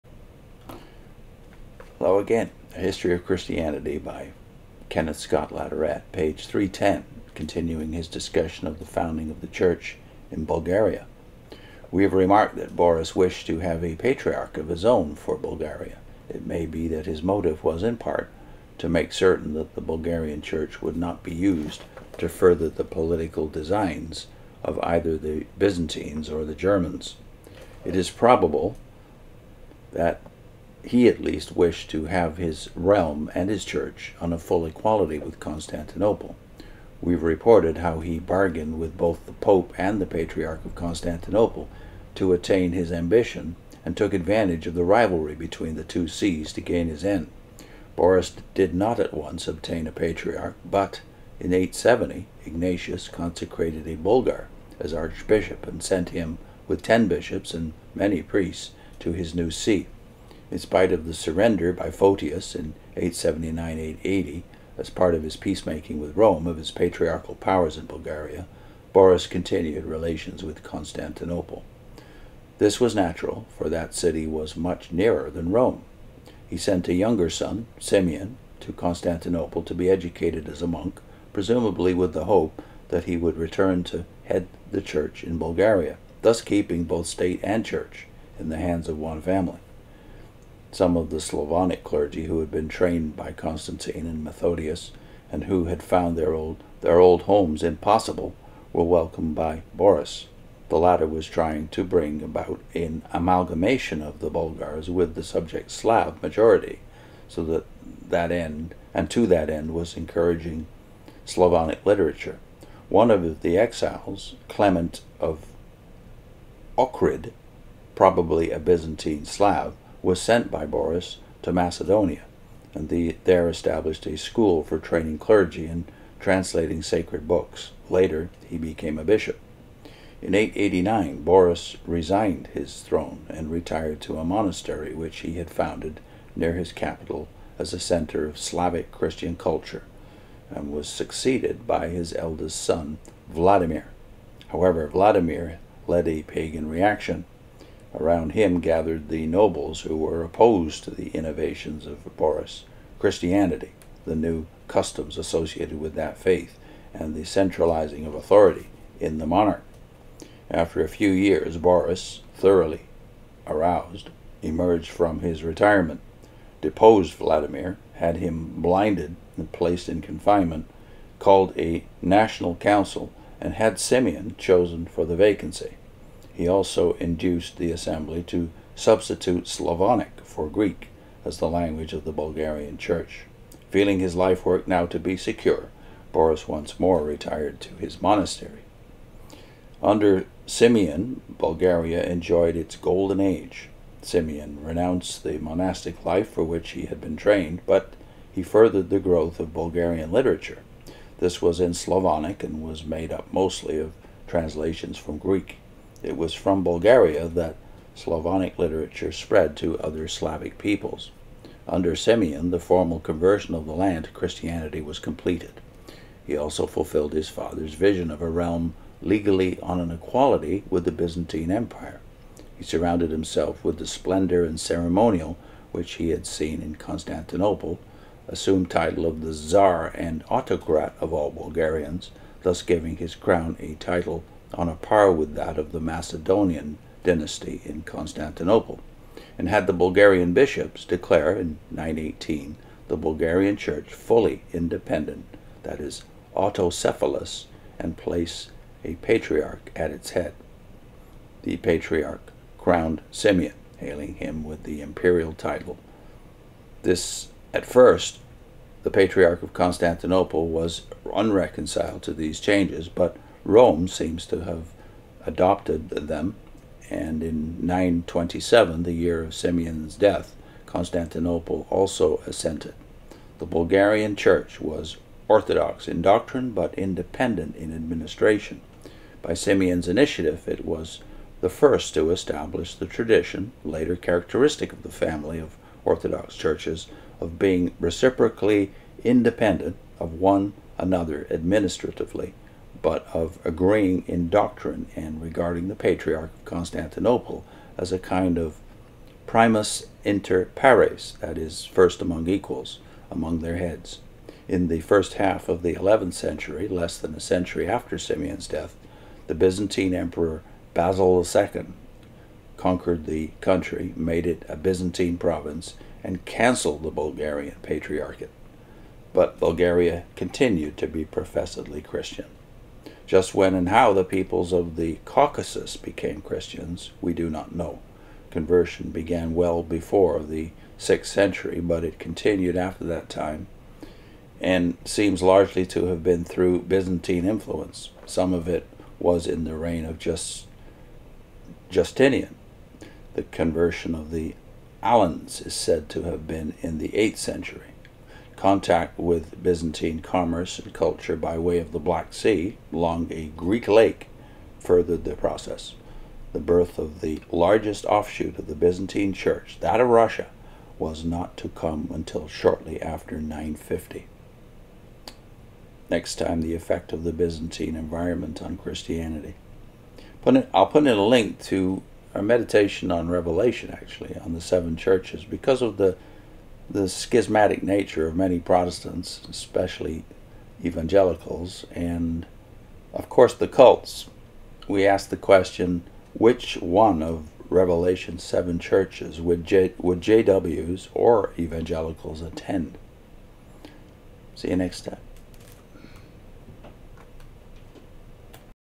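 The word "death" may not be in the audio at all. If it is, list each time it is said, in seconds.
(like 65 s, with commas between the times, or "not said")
269 s, 308 s.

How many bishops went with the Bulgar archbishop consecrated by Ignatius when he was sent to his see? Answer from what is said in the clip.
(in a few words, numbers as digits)
10.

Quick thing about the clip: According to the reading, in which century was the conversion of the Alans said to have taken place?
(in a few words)
8th century.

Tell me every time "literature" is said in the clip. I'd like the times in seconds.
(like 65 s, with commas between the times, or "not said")
111 s, 200 s, 208 s.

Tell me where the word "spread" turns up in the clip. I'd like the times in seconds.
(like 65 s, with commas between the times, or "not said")
209 s.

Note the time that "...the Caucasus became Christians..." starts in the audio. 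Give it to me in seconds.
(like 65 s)
324 s.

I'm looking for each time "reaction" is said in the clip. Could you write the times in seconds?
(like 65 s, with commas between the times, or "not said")
146 s.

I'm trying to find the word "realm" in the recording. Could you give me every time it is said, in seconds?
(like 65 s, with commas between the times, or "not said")
32 s, 218 s.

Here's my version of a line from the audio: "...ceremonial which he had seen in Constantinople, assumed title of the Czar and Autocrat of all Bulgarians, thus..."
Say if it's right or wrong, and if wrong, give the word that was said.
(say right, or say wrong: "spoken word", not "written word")
right.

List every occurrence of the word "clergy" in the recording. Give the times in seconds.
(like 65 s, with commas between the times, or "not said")
91 s, 125 s.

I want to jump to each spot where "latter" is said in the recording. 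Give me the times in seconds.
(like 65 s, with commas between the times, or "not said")
100 s.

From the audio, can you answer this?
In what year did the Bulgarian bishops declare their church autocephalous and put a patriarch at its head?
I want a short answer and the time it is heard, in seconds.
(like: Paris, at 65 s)
918, at 241 s.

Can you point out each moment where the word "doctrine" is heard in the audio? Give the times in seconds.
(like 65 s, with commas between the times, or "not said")
276 s, 294 s.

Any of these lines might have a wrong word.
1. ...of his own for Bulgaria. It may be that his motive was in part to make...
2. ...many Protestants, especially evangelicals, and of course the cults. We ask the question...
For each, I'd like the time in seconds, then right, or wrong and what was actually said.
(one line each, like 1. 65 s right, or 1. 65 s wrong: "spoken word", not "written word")
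1. 14 s right
2. 378 s right.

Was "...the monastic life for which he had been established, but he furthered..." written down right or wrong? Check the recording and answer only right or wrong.
wrong.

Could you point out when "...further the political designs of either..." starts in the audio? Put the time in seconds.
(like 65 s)
22 s.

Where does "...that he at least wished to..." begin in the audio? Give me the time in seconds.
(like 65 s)
29 s.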